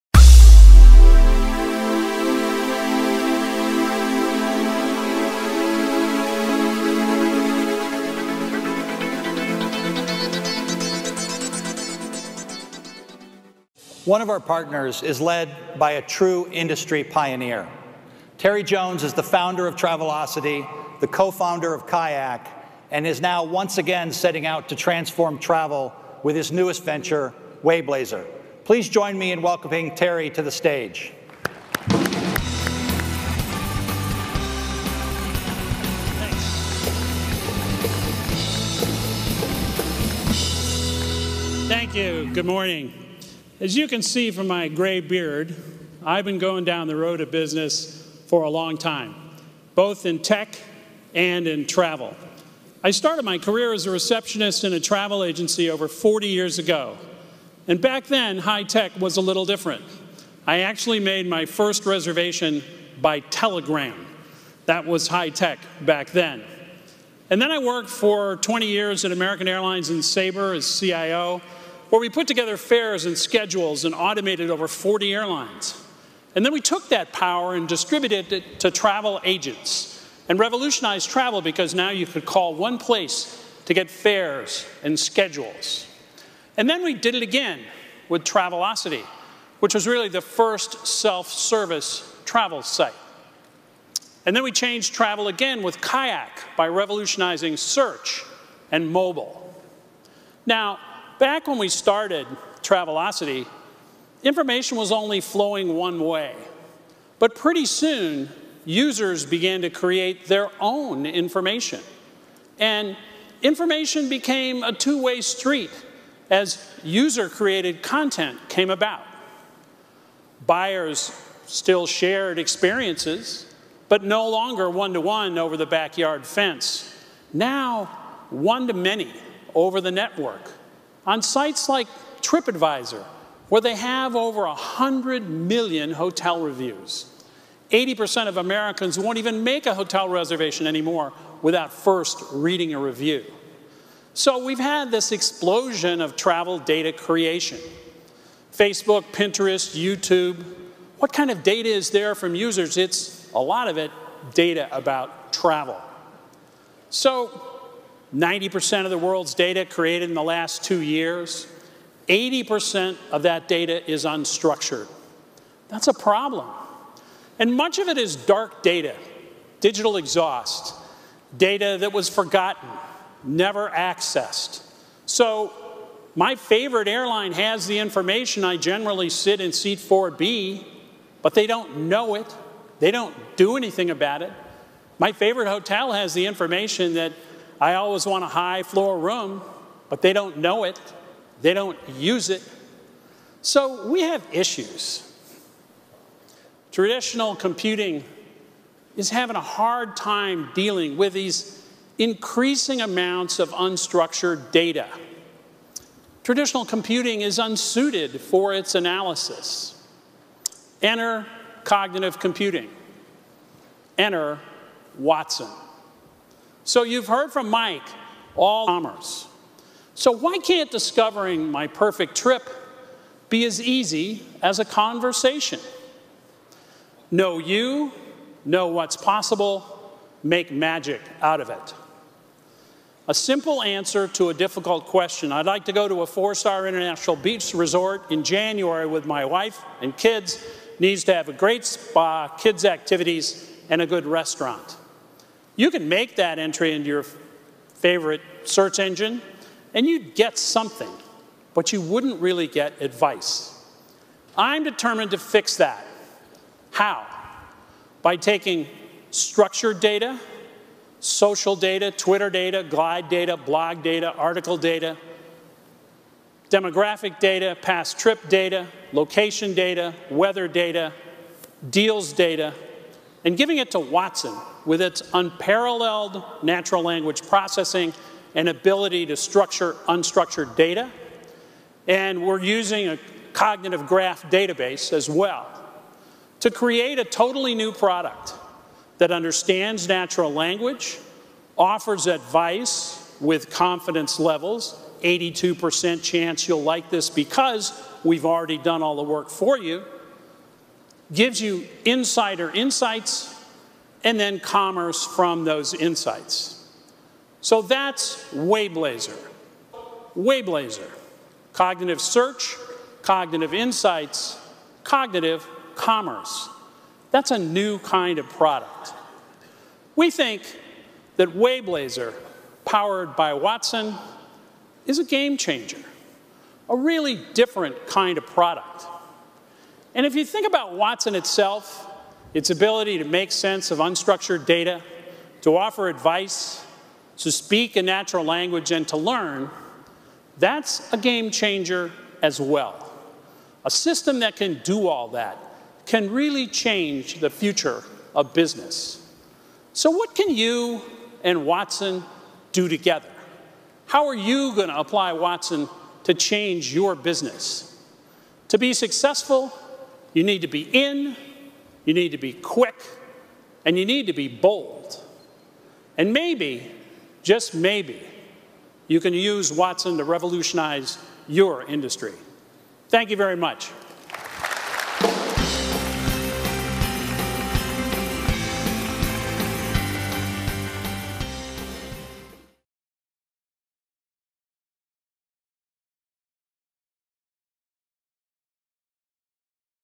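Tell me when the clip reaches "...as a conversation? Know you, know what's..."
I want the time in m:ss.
3:44.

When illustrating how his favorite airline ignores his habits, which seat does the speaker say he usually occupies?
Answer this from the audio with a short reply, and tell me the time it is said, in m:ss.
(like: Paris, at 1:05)
4B, at 2:59.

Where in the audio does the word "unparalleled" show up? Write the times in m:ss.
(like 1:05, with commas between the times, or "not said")
4:35.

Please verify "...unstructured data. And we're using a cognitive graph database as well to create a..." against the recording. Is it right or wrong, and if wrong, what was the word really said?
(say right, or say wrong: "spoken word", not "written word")
right.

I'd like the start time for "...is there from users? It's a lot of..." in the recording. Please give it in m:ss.
2:31.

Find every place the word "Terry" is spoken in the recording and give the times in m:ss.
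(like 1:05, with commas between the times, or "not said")
0:18, 0:29.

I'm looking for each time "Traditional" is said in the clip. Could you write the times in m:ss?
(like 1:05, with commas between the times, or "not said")
3:16, 3:26.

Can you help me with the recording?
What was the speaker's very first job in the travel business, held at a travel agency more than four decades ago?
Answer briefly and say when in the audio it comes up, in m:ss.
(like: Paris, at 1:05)
receptionist, at 0:53.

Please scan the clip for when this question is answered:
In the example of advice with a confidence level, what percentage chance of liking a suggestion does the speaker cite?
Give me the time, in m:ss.
4:55.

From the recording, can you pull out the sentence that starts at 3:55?
I'd like to go to a four star international beach resort in January with my wife and kids.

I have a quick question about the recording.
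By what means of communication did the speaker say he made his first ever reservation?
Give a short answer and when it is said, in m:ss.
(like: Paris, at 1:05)
telegram, at 1:03.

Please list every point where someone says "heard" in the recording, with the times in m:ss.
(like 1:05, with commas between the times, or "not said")
3:37.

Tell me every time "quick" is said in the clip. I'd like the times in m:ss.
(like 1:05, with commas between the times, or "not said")
6:02.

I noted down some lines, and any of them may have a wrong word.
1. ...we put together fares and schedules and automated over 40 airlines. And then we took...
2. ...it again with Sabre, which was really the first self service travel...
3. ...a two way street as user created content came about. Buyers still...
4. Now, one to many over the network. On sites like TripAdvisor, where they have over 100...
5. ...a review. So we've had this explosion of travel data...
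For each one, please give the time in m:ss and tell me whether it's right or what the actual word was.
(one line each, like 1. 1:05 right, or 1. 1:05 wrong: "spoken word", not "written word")
1. 1:11 right
2. 1:27 wrong: "Travelocity", not "Sabre"
3. 1:54 right
4. 2:07 right
5. 2:22 right.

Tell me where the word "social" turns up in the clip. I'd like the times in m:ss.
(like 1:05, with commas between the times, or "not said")
4:20.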